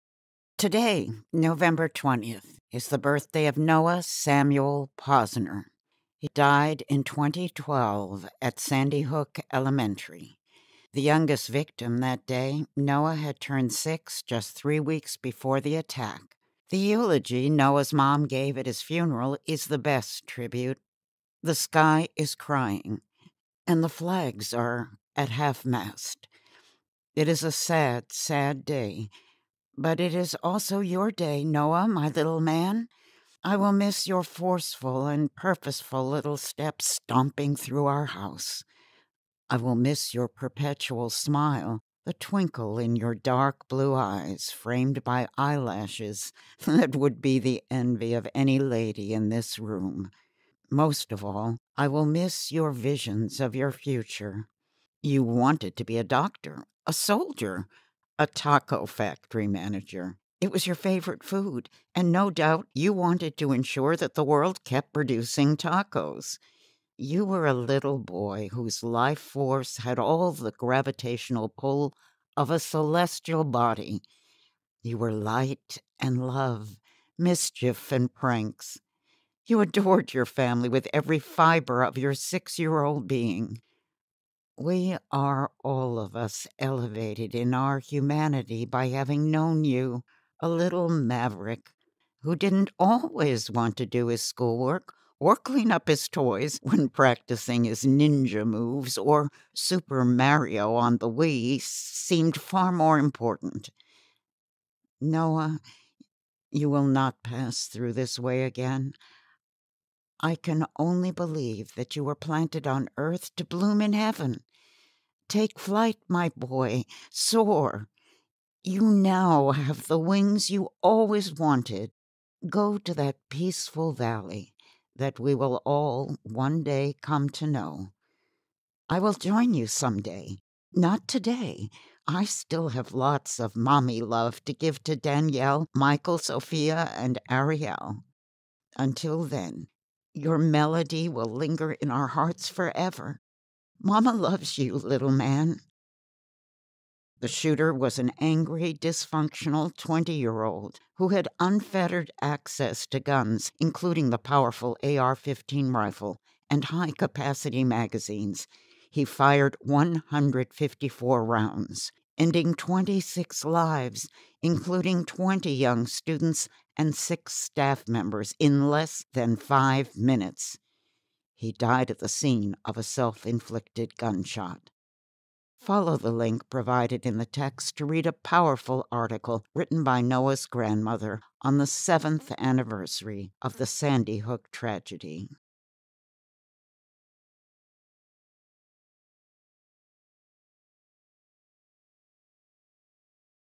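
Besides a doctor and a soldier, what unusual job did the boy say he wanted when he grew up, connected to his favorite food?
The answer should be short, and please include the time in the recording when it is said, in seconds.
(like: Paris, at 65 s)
Taco factory manager, at 58 s.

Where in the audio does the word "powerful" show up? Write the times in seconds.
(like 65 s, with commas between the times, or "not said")
154 s, 178 s.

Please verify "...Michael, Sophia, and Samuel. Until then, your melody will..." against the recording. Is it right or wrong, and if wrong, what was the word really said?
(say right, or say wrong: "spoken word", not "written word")
wrong: "Ariel", not "Samuel".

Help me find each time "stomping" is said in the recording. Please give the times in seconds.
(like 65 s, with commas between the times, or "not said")
37 s.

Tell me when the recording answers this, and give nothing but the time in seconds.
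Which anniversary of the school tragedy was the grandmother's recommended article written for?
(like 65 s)
181 s.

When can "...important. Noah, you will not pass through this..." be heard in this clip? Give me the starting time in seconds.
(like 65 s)
102 s.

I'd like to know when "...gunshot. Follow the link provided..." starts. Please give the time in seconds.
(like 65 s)
173 s.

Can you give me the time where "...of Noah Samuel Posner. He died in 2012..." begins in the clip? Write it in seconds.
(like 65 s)
3 s.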